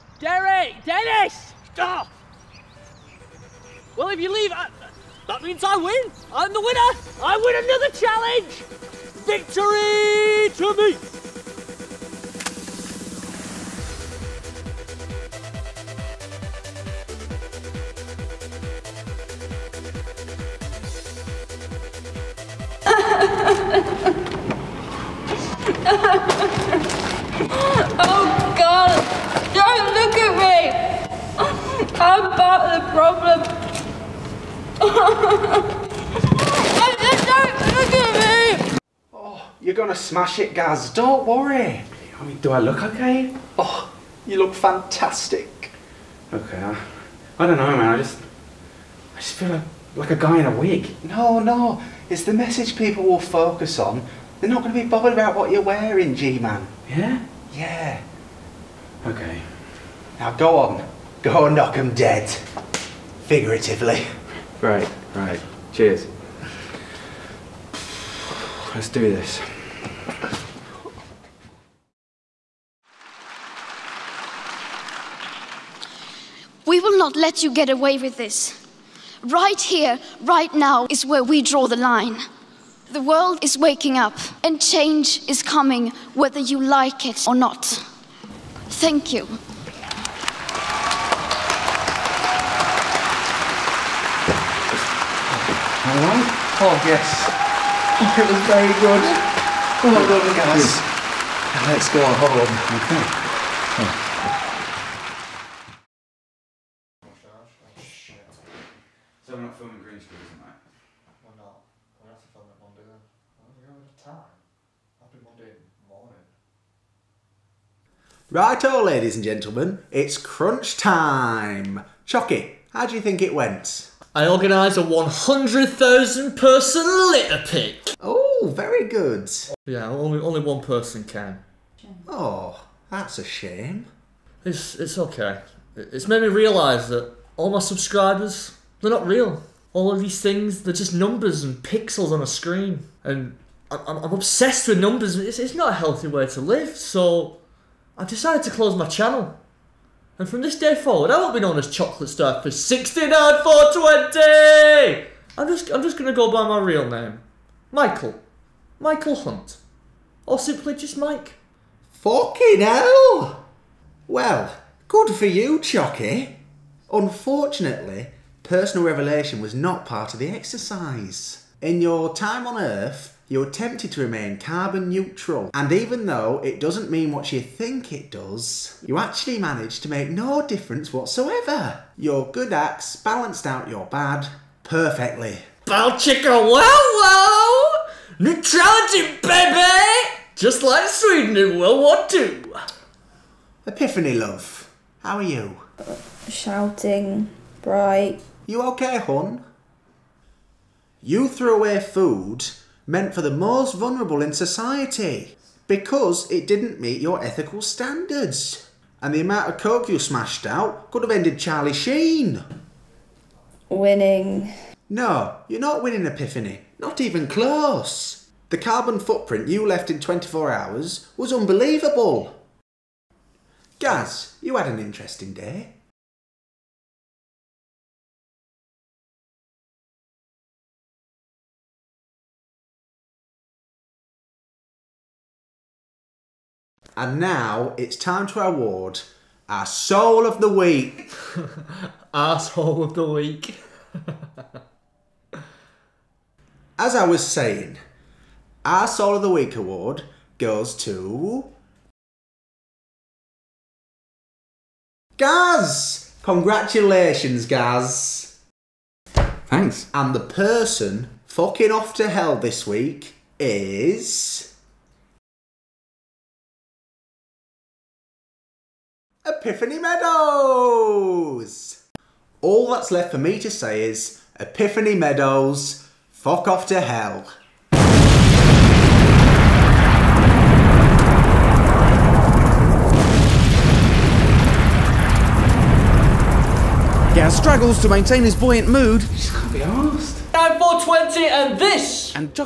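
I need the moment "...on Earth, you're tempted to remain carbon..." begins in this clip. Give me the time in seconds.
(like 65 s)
172 s.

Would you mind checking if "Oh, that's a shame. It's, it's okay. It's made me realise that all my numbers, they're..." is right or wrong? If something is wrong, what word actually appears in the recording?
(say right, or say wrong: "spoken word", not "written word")
wrong: "subscribers", not "numbers".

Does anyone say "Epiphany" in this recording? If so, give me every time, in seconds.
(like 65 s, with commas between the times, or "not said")
193 s, 216 s, 269 s, 274 s.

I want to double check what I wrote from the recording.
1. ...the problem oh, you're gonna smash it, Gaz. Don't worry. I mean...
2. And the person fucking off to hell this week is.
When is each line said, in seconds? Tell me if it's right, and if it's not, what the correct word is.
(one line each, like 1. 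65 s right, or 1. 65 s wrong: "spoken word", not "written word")
1. 32 s right
2. 259 s right.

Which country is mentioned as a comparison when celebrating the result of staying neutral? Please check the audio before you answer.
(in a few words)
Sweden.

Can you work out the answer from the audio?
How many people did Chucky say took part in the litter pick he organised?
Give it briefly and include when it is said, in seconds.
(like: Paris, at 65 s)
100,000, at 124 s.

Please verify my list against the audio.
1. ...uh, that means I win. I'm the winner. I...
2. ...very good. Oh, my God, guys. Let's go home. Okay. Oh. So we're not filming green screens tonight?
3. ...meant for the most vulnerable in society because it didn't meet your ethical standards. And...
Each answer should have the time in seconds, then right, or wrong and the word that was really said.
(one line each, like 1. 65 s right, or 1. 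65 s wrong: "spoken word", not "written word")
1. 4 s right
2. 98 s right
3. 202 s right.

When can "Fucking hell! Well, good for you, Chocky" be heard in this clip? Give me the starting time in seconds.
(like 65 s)
161 s.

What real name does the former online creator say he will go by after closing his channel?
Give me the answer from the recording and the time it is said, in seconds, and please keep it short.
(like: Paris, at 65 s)
Michael Hunt, at 158 s.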